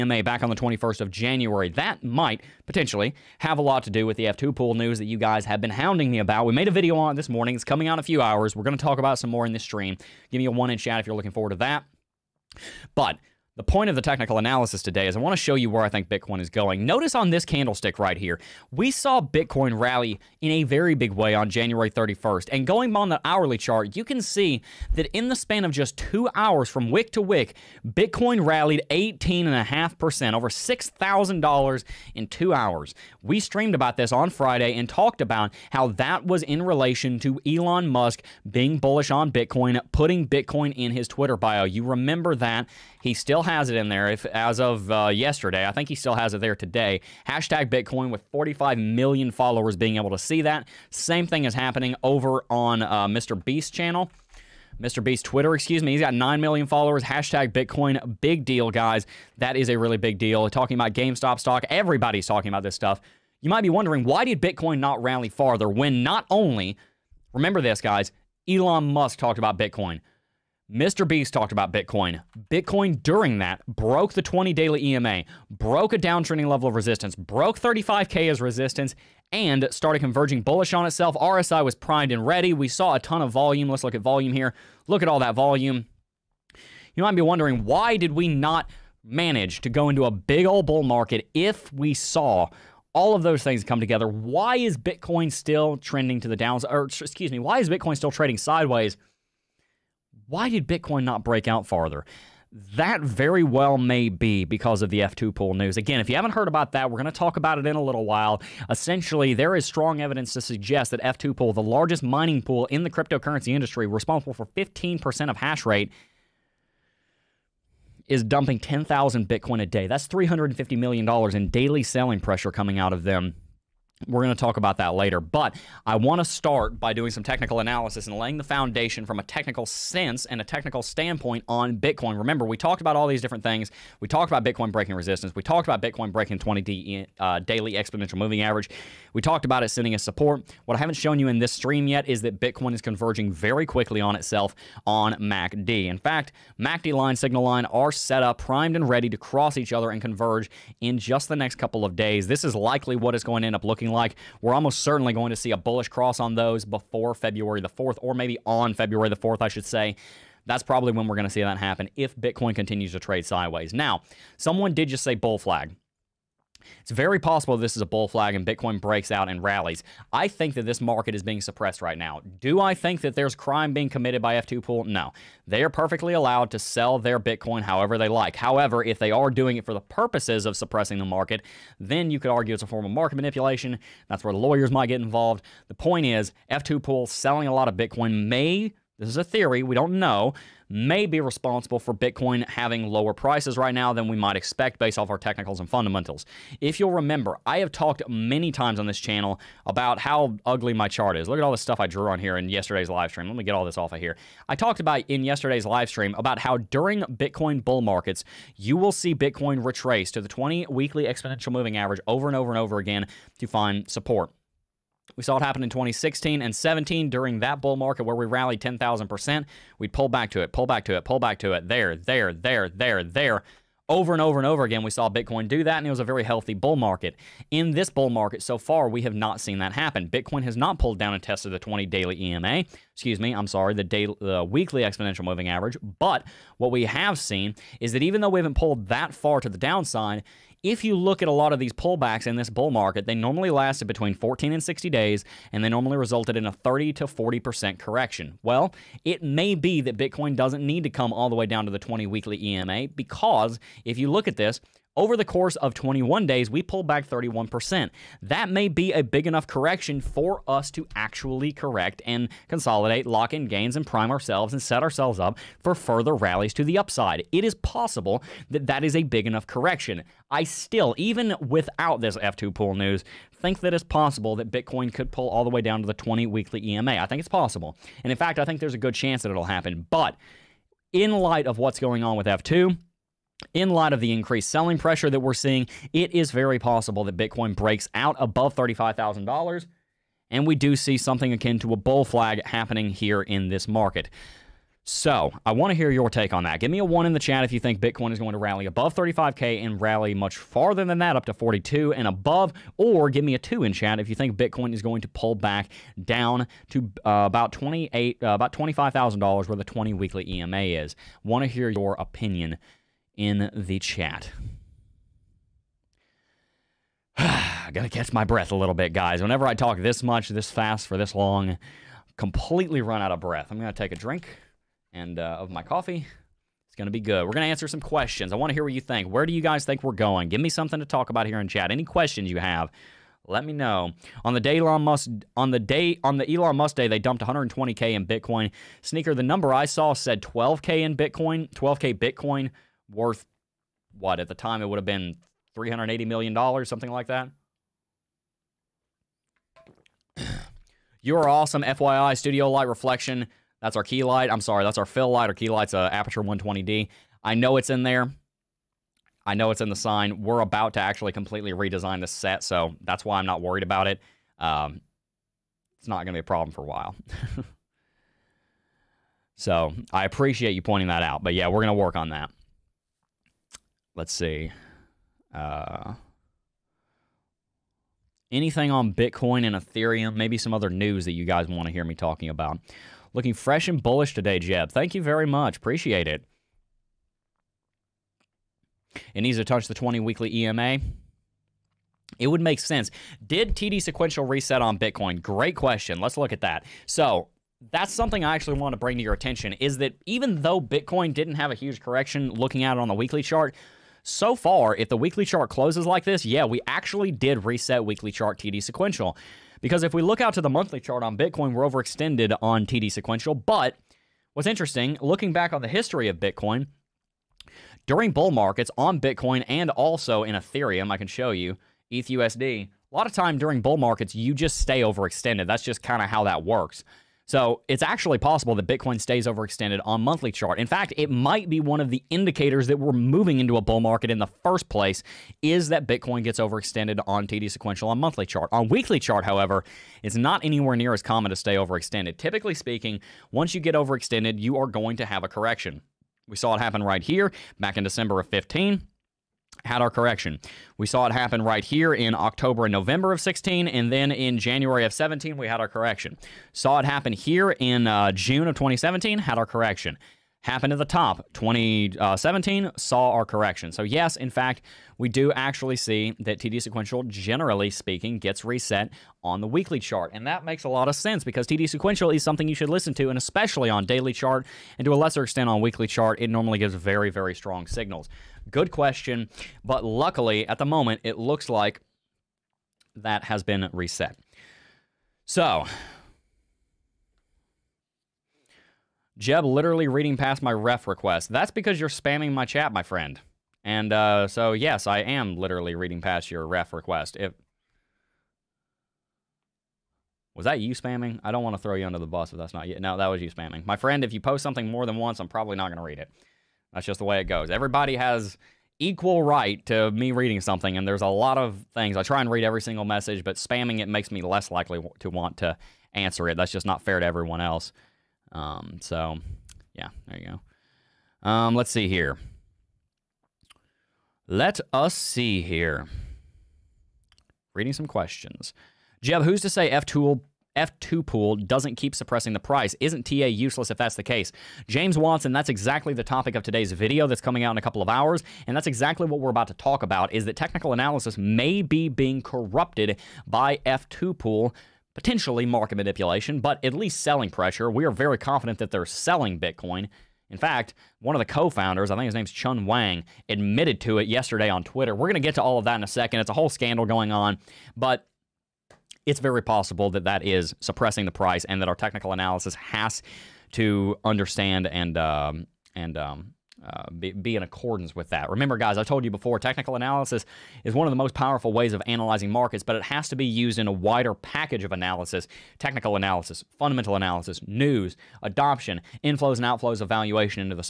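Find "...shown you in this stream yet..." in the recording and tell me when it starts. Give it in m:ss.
2:20.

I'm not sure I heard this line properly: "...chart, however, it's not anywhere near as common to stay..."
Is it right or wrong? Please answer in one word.
right.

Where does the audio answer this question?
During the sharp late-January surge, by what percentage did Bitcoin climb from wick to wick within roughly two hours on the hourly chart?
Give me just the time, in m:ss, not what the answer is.
0:28.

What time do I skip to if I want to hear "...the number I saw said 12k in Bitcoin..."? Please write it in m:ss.
5:39.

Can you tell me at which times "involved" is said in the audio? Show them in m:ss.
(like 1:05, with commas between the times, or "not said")
3:05.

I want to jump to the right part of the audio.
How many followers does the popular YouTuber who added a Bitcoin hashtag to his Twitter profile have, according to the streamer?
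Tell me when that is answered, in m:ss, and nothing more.
0:56.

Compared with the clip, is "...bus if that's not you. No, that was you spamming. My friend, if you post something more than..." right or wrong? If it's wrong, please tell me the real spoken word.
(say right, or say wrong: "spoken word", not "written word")
right.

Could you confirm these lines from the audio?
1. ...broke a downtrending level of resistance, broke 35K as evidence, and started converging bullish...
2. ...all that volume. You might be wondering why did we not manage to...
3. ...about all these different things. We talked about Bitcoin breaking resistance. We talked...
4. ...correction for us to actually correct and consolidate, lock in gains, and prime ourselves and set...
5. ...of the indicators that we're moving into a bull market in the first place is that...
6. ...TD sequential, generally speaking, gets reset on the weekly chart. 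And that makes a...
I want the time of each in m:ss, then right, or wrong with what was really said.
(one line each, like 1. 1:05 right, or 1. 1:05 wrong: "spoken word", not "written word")
1. 1:15 wrong: "resistance", not "evidence"
2. 1:25 right
3. 2:12 right
4. 4:19 right
5. 7:11 right
6. 7:46 right.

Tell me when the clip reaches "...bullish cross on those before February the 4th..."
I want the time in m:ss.
2:35.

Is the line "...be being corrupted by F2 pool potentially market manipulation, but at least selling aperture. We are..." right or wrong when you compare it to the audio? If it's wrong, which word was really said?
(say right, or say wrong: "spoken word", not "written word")
wrong: "pressure", not "aperture".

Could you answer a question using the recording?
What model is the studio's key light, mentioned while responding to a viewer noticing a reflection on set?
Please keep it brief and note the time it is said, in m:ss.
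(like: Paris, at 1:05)
Aperture 120D, at 5:55.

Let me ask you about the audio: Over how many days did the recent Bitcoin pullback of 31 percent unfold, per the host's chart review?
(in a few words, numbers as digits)
21.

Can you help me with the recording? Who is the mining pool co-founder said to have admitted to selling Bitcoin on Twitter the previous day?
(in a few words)
Chun Wang.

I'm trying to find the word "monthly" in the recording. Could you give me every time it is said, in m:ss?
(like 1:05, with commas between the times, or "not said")
6:50, 7:10, 7:17.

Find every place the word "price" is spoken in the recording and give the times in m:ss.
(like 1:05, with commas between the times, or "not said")
3:13, 8:52, 9:21.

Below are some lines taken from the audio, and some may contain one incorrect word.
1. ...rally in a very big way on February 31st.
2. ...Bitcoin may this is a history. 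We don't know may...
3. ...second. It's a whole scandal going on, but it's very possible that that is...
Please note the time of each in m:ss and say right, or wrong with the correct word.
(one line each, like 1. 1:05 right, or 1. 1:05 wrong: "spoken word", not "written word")
1. 0:19 wrong: "January", not "February"
2. 3:07 wrong: "theory", not "history"
3. 9:15 right.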